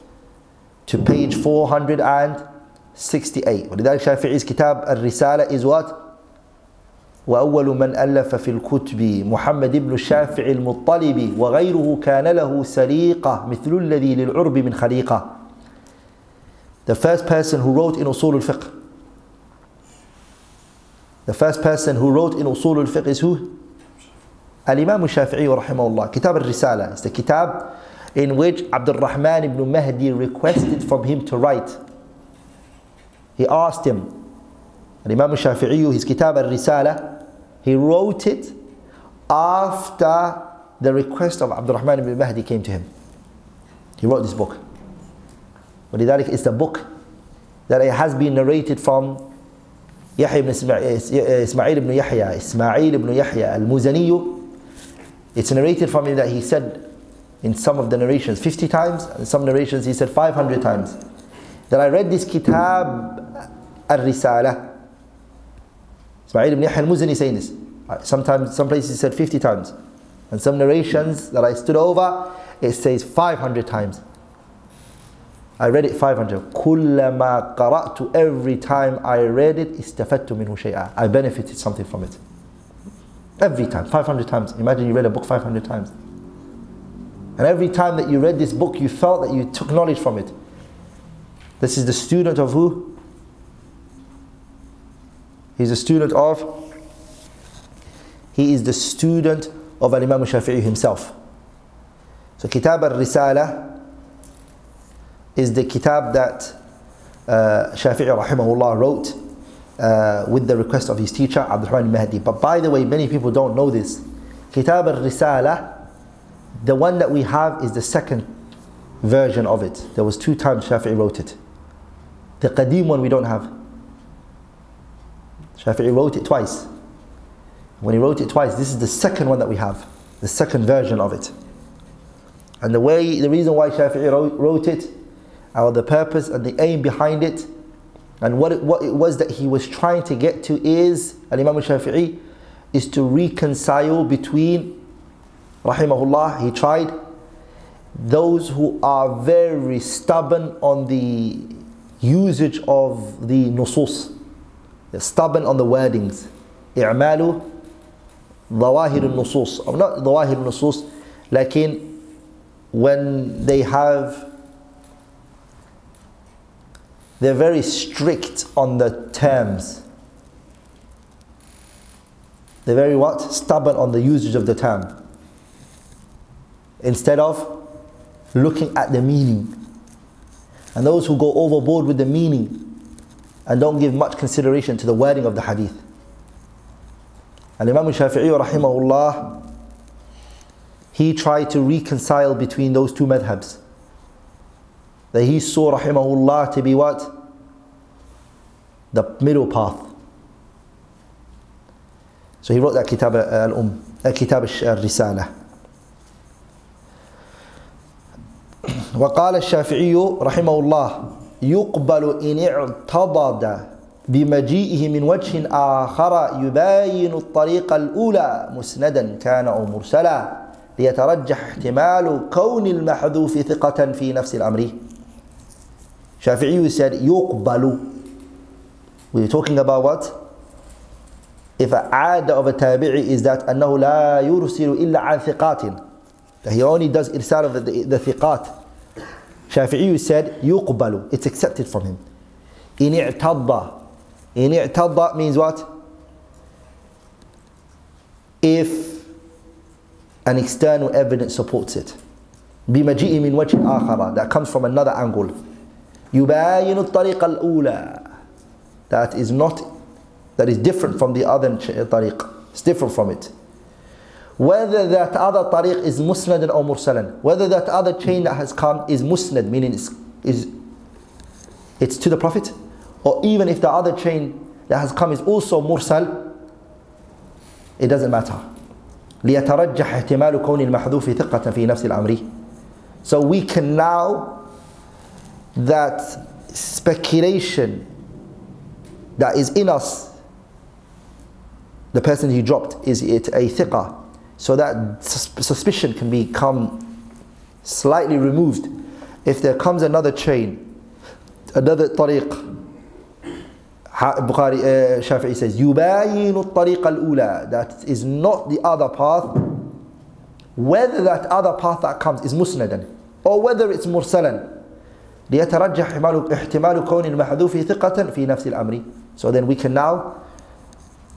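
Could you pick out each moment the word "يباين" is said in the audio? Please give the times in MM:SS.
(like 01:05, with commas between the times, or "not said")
03:36, 04:16, 05:05.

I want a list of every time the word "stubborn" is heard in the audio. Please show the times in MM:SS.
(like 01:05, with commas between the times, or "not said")
02:29, 02:34, 02:53.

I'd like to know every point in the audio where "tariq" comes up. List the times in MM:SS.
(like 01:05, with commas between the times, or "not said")
04:25, 05:01.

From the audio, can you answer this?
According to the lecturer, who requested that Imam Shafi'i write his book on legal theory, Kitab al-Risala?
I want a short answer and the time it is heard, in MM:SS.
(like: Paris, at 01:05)
Abdul Rahman ibn Mahdi, at 00:28.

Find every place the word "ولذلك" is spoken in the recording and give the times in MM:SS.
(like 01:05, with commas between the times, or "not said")
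00:03, 00:45.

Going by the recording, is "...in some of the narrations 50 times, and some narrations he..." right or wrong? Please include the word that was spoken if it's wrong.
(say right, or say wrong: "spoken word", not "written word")
right.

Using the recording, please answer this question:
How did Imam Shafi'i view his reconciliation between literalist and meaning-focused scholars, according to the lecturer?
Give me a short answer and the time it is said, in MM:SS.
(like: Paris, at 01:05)
The middle path, at 03:18.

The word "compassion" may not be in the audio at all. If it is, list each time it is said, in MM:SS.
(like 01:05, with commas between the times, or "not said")
not said.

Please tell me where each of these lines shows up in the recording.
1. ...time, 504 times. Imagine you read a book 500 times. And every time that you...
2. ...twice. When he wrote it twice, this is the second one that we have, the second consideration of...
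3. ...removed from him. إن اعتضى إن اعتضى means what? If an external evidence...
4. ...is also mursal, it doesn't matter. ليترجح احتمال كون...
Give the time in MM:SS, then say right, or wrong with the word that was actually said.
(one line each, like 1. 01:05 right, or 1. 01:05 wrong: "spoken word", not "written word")
1. 01:23 wrong: "500", not "504"
2. 02:06 wrong: "version", not "consideration"
3. 04:01 wrong: "accepted", not "removed"
4. 04:35 right.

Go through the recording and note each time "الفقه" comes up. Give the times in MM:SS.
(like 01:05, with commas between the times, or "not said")
00:18, 00:22.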